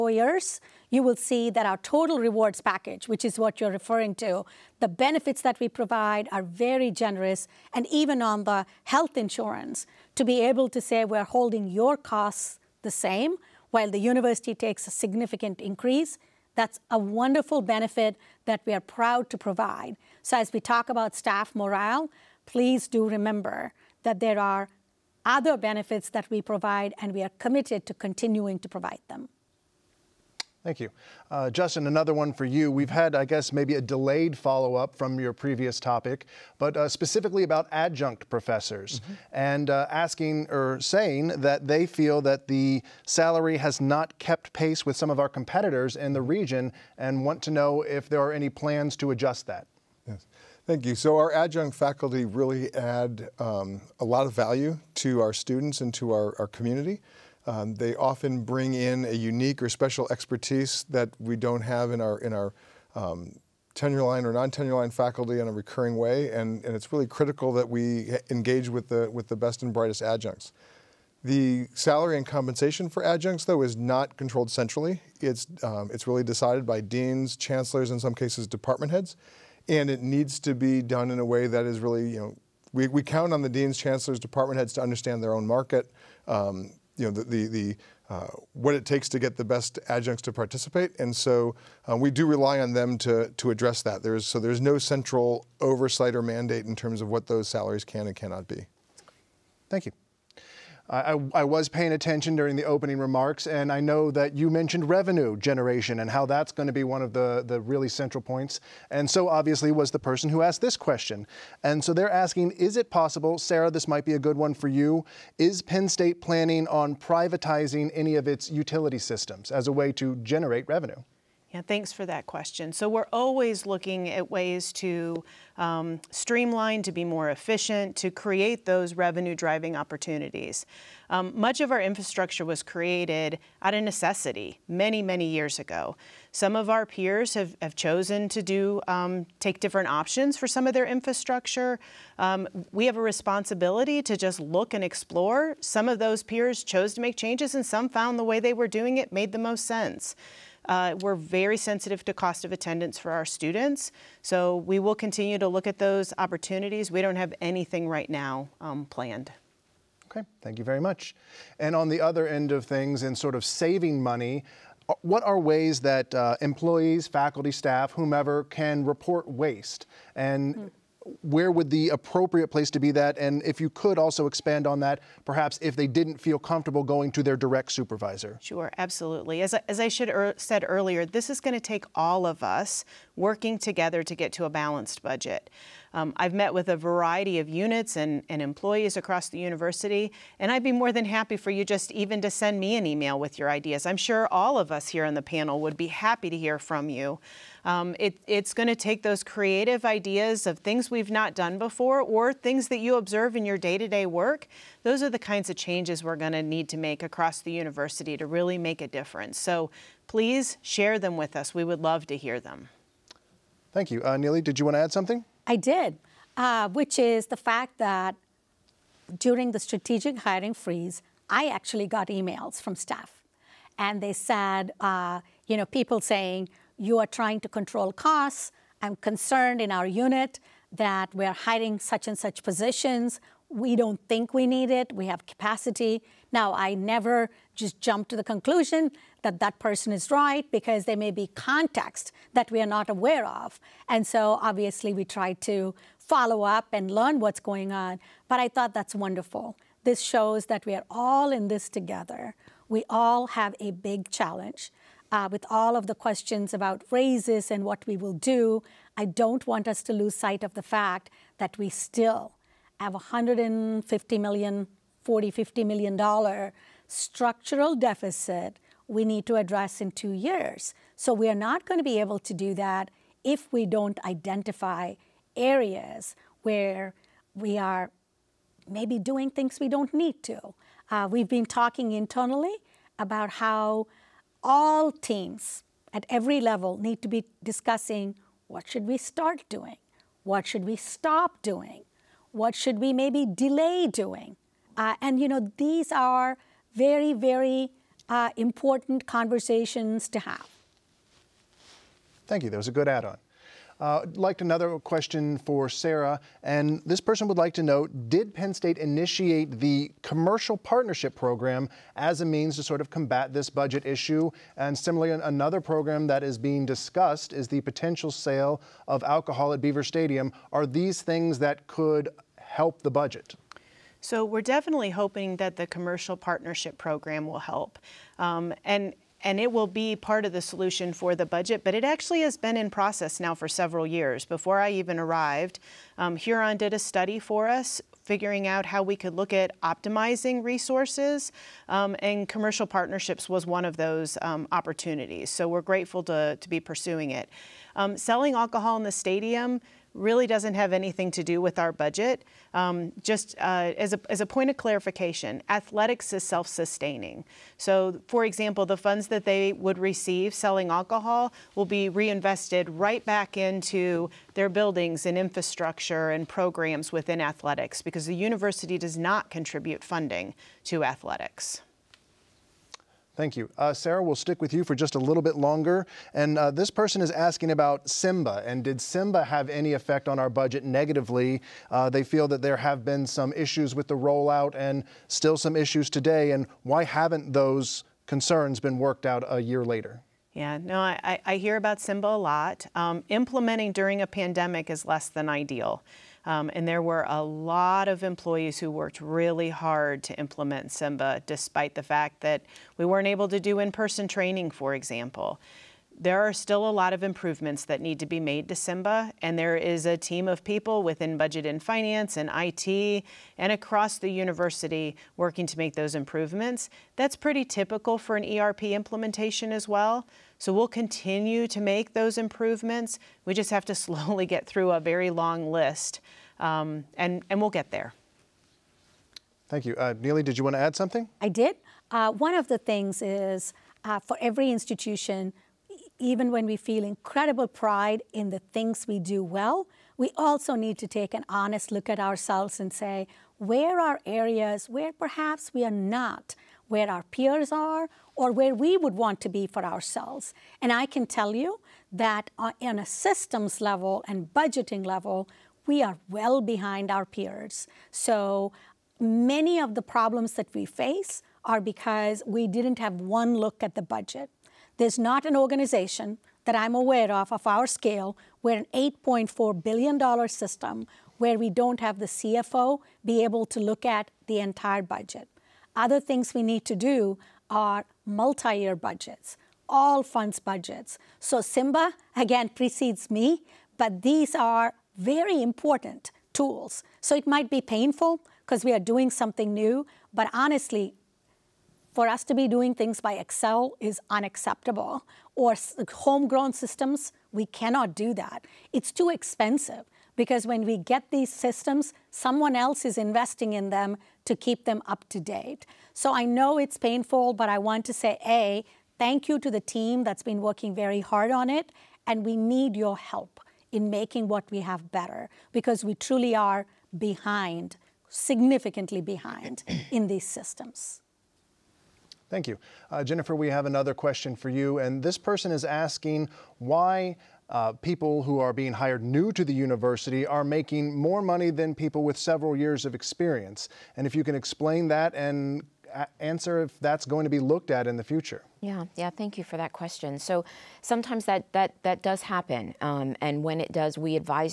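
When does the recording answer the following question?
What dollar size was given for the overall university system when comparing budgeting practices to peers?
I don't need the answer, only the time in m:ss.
7:48.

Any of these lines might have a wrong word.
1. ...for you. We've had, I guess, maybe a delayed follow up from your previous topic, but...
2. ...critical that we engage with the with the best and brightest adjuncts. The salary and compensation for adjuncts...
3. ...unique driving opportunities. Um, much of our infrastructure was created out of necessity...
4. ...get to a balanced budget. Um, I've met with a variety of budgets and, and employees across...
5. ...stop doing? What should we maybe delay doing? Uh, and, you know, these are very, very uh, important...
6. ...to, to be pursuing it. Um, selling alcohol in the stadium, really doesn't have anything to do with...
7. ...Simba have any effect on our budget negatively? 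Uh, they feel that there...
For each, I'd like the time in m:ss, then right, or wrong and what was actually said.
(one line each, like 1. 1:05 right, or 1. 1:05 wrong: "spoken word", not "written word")
1. 0:32 right
2. 1:07 right
3. 2:08 wrong: "revenue", not "unique"
4. 3:04 wrong: "units", not "budgets"
5. 4:50 right
6. 5:46 right
7. 6:18 right.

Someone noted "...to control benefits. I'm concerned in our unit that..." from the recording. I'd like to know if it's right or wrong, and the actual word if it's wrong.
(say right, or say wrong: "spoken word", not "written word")
wrong: "costs", not "benefits".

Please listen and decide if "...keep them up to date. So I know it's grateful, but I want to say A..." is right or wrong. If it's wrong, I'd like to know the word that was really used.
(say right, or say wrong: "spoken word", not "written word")
wrong: "painful", not "grateful".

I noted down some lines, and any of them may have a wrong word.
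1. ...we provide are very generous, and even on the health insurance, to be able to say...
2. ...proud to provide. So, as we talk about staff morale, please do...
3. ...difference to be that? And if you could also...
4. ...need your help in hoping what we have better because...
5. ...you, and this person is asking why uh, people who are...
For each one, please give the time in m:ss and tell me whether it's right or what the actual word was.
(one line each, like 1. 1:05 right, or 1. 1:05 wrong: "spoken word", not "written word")
1. 0:05 right
2. 0:18 right
3. 2:52 wrong: "place", not "difference"
4. 8:32 wrong: "making", not "hoping"
5. 8:44 right.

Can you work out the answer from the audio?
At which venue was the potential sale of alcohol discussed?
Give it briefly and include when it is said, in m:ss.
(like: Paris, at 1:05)
Beaver Stadium, at 5:19.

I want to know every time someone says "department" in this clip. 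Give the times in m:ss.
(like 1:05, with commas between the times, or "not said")
1:18, 1:24.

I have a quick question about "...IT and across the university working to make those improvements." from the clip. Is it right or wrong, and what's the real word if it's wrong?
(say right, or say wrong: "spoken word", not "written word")
right.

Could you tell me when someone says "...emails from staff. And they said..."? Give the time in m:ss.
3:42.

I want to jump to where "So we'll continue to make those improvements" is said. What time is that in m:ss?
7:00.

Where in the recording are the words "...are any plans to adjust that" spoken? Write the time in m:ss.
0:48.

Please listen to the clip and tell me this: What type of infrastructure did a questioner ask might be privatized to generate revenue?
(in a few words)
Utility systems.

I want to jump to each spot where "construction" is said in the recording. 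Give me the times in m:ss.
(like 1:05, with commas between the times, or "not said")
not said.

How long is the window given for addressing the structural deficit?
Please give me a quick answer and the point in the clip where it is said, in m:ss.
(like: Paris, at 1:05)
Two years, at 4:29.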